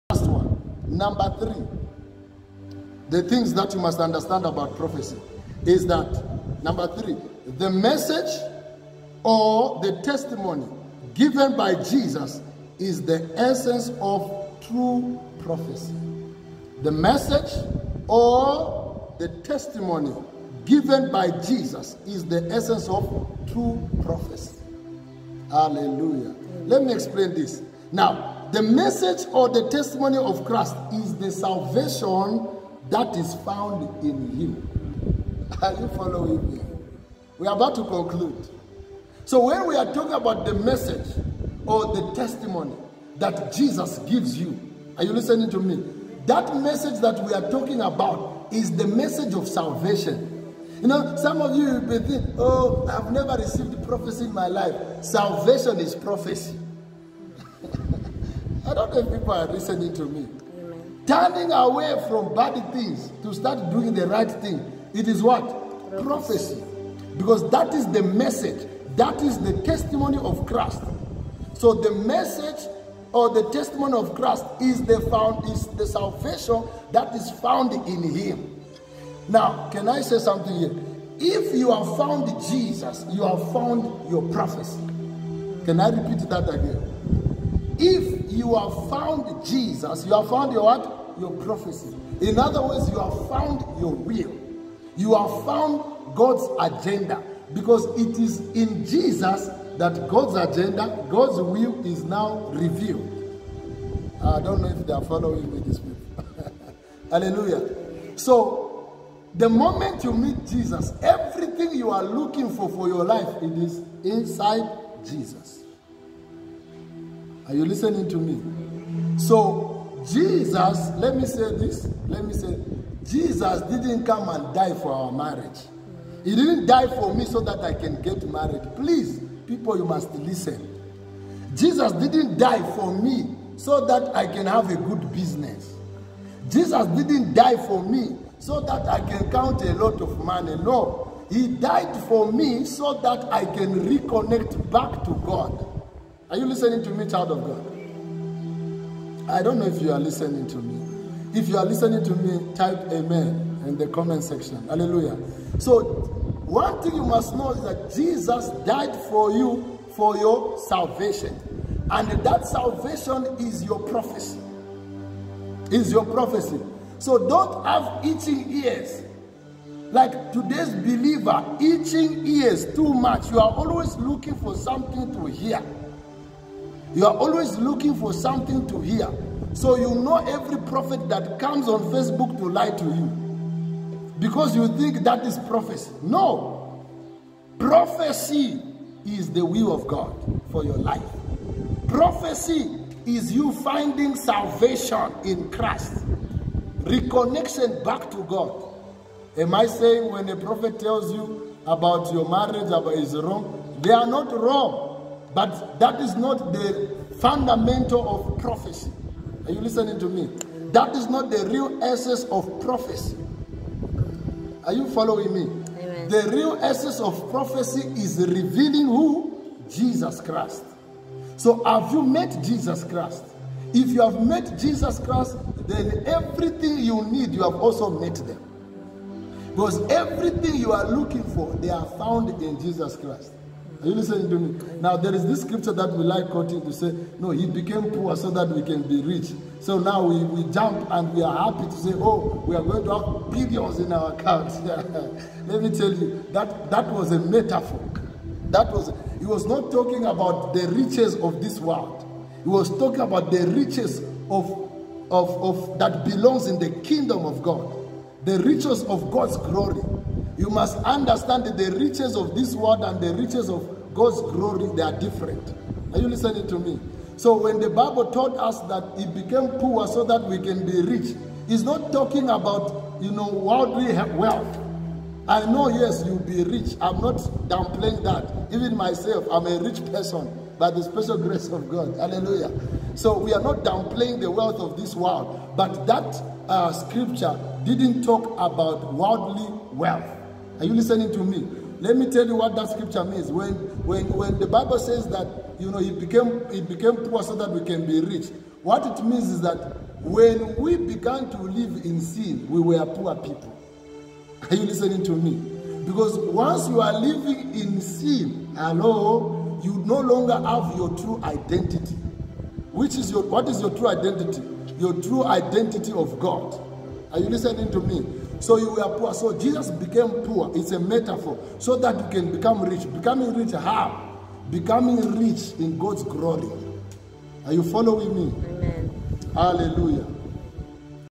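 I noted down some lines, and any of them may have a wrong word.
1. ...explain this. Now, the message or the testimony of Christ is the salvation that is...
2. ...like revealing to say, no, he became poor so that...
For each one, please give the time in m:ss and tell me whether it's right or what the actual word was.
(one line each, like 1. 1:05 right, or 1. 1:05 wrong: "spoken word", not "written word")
1. 0:26 right
2. 3:56 wrong: "quoting", not "revealing".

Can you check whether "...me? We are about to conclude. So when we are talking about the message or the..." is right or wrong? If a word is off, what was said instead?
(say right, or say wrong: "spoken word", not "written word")
right.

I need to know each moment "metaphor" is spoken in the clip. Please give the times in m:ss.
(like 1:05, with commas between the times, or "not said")
4:07, 5:20.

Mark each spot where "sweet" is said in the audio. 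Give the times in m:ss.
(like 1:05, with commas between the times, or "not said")
not said.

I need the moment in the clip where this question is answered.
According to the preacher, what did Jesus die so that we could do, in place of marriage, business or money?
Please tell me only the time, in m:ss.
2:23.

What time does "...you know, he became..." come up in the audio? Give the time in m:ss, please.
4:55.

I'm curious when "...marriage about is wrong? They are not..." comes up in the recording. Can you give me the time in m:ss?
3:22.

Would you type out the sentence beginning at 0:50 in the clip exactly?
You know, some of you will be thinking, oh, I've never received prophecy in my life.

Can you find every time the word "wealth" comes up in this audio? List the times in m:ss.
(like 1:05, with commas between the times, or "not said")
4:34, 4:44, 4:49.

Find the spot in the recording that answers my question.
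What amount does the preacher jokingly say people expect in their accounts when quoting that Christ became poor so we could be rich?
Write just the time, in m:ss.
4:03.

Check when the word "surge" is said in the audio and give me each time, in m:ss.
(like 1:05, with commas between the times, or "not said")
not said.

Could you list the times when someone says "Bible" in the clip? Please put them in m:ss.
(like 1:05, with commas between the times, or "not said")
4:27, 4:54.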